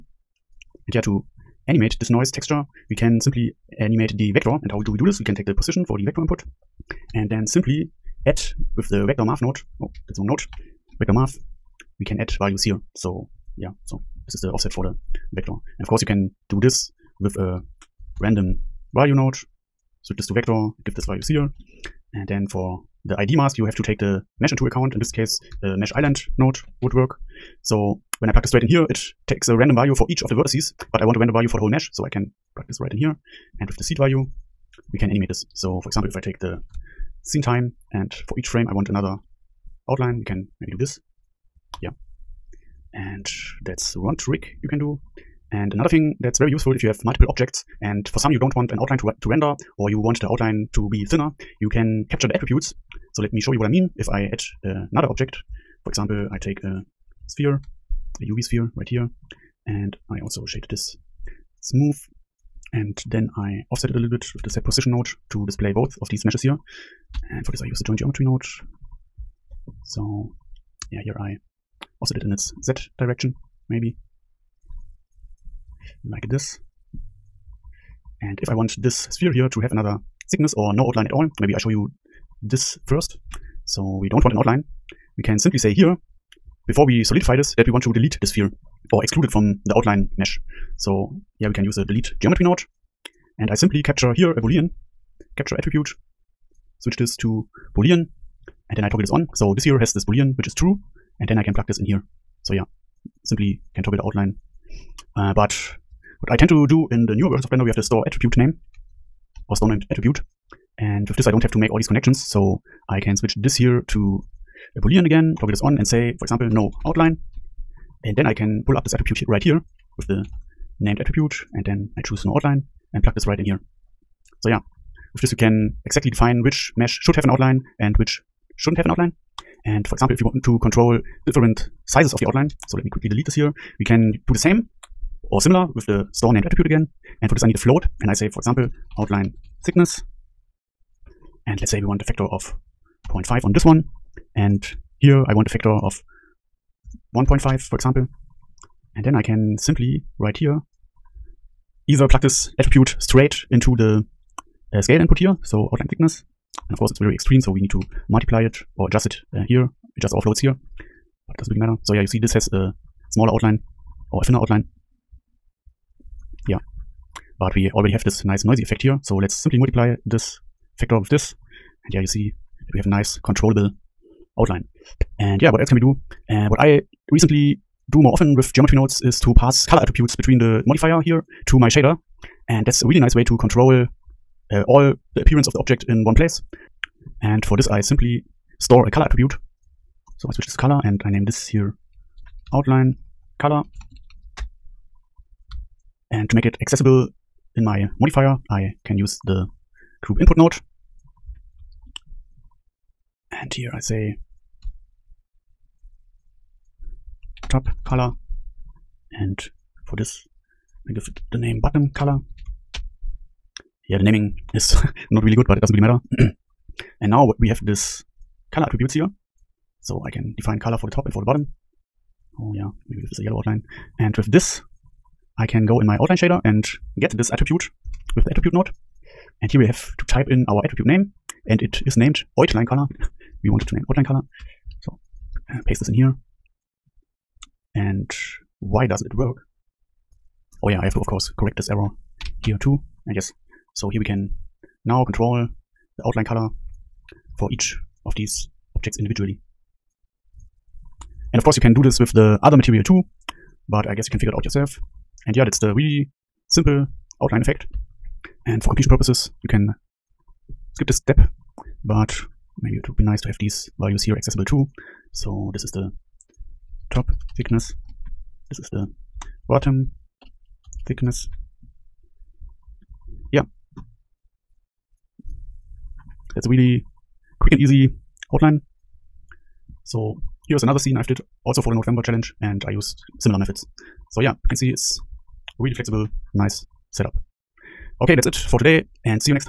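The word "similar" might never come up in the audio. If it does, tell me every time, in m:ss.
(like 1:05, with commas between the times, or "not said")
2:15, 4:43.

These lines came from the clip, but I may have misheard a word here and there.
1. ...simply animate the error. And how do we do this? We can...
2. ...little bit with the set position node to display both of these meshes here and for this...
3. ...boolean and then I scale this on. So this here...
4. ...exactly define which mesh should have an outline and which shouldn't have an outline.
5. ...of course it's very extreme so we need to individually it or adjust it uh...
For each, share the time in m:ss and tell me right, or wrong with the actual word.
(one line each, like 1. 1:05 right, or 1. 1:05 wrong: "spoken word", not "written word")
1. 0:03 wrong: "vector", not "error"
2. 1:03 right
3. 1:37 wrong: "toggle", not "scale"
4. 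2:05 right
5. 2:36 wrong: "multiply", not "individually".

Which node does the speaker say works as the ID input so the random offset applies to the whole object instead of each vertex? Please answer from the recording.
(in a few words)
mesh island.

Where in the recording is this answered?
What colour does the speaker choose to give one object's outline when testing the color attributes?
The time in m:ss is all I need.
3:43.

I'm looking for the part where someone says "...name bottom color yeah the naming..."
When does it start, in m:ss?
3:31.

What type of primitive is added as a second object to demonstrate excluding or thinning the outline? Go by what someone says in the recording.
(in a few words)
UV sphere.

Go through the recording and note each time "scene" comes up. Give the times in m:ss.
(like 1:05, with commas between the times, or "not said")
0:37, 4:40.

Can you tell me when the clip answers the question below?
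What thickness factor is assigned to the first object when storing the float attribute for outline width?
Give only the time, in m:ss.
2:23.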